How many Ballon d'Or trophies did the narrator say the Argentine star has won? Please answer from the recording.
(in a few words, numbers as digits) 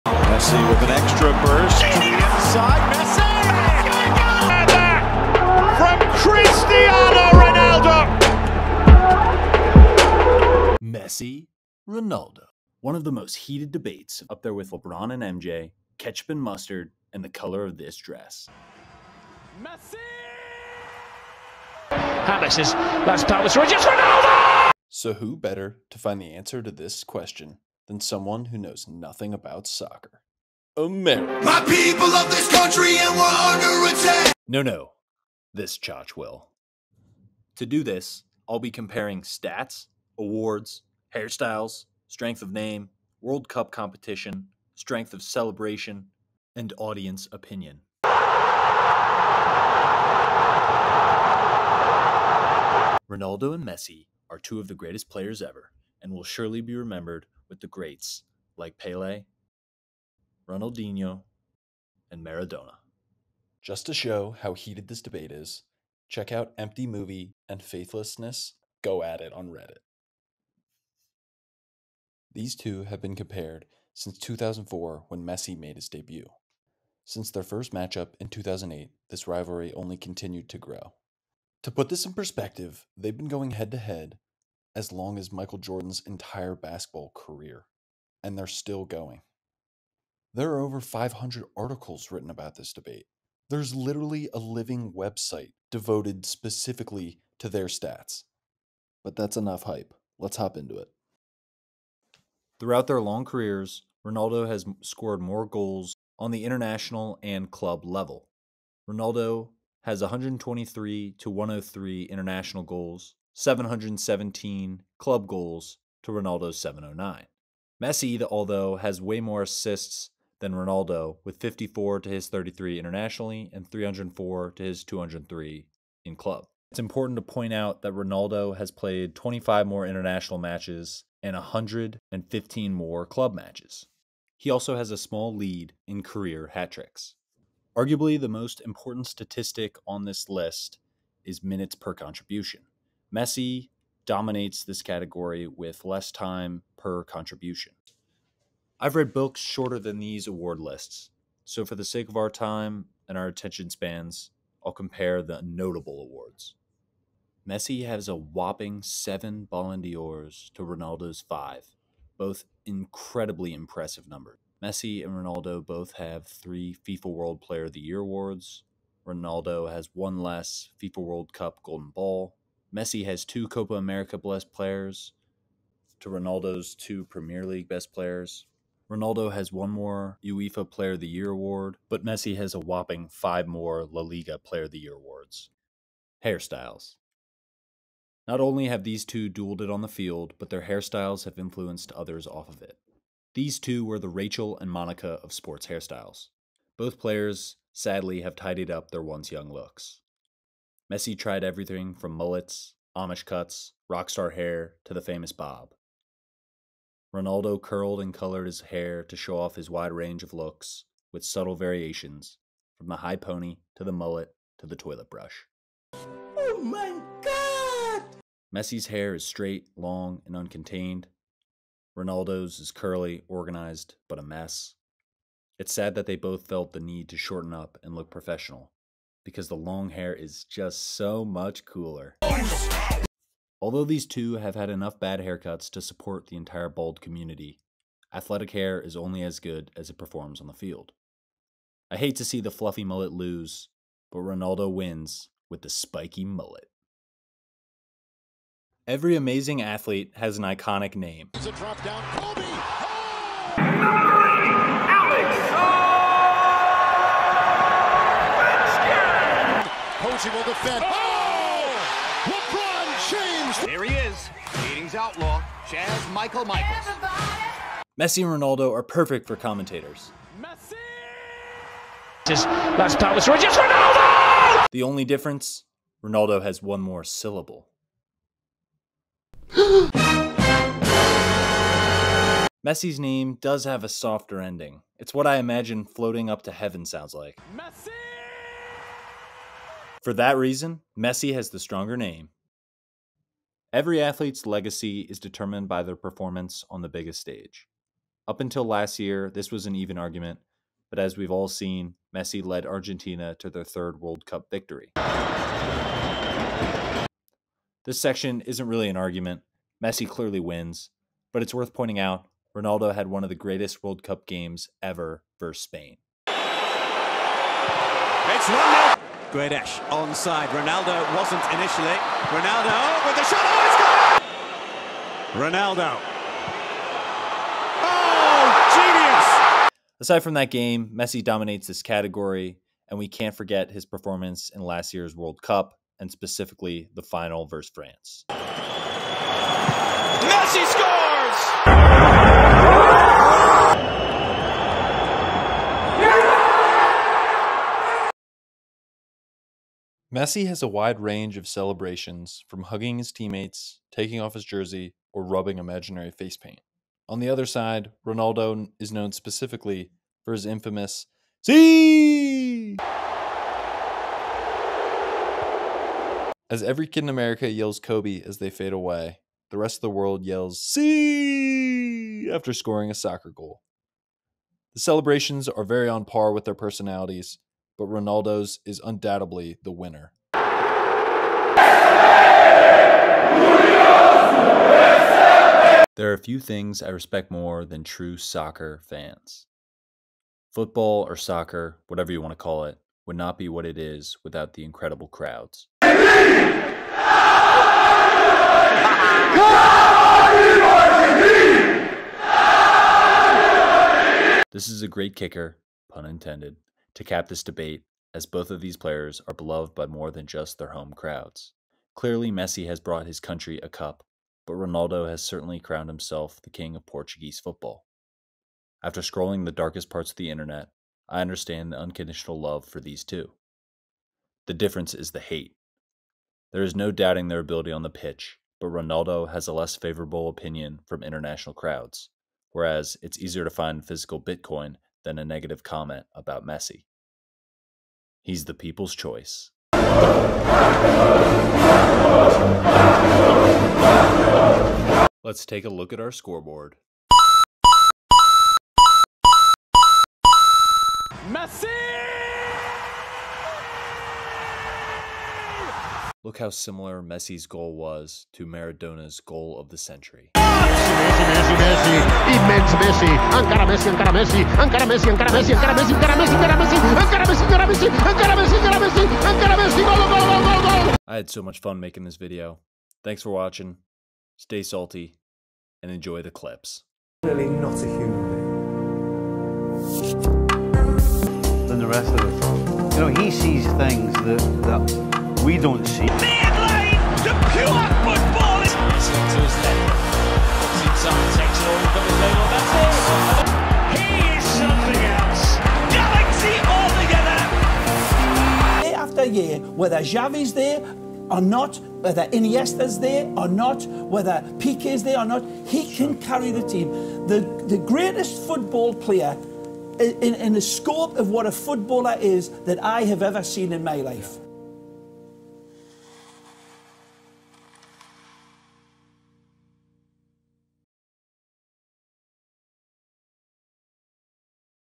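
seven.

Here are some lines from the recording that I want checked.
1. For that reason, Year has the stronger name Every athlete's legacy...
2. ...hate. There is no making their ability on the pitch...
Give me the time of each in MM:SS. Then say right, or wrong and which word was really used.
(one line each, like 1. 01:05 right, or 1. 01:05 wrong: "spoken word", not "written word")
1. 04:50 wrong: "Messi", not "Year"
2. 07:05 wrong: "doubting", not "making".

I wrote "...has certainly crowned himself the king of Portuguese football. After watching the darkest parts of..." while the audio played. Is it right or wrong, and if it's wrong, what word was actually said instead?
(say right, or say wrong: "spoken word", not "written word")
wrong: "scrolling", not "watching".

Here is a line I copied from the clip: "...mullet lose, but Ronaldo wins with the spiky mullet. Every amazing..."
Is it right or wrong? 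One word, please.
right.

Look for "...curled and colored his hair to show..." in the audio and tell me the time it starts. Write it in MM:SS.
03:27.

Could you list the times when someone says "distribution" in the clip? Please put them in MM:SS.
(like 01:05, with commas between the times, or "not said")
not said.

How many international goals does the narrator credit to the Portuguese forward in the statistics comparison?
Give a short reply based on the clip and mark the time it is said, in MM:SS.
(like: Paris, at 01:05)
123, at 01:50.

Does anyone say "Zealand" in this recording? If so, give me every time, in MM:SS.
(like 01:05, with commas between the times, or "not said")
not said.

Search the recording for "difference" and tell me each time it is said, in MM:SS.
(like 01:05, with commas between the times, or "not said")
04:35, 07:04.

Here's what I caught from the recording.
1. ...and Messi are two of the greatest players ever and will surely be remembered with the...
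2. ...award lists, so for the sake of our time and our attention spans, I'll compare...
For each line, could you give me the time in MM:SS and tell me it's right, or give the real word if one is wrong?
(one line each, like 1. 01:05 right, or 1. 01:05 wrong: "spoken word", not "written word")
1. 00:53 right
2. 02:30 right.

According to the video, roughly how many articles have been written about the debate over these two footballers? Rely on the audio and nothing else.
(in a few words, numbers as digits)
500.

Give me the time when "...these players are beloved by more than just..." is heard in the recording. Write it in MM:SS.
06:48.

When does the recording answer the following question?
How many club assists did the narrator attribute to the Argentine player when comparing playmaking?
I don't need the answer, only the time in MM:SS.
02:03.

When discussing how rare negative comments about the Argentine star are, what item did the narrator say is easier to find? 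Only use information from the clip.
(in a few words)
physical Bitcoin.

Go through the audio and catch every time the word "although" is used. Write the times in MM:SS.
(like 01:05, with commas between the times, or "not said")
01:58, 03:53.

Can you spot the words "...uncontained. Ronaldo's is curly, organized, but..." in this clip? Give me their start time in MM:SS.
03:40.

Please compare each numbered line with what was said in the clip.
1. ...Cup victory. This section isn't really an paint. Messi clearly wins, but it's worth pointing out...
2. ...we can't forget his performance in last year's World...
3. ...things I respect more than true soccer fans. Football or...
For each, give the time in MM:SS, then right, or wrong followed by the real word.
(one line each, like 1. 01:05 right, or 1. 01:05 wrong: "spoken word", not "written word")
1. 05:04 wrong: "argument", not "paint"
2. 05:32 right
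3. 06:26 right.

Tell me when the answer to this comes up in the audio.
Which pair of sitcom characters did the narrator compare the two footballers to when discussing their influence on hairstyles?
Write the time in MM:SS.
03:14.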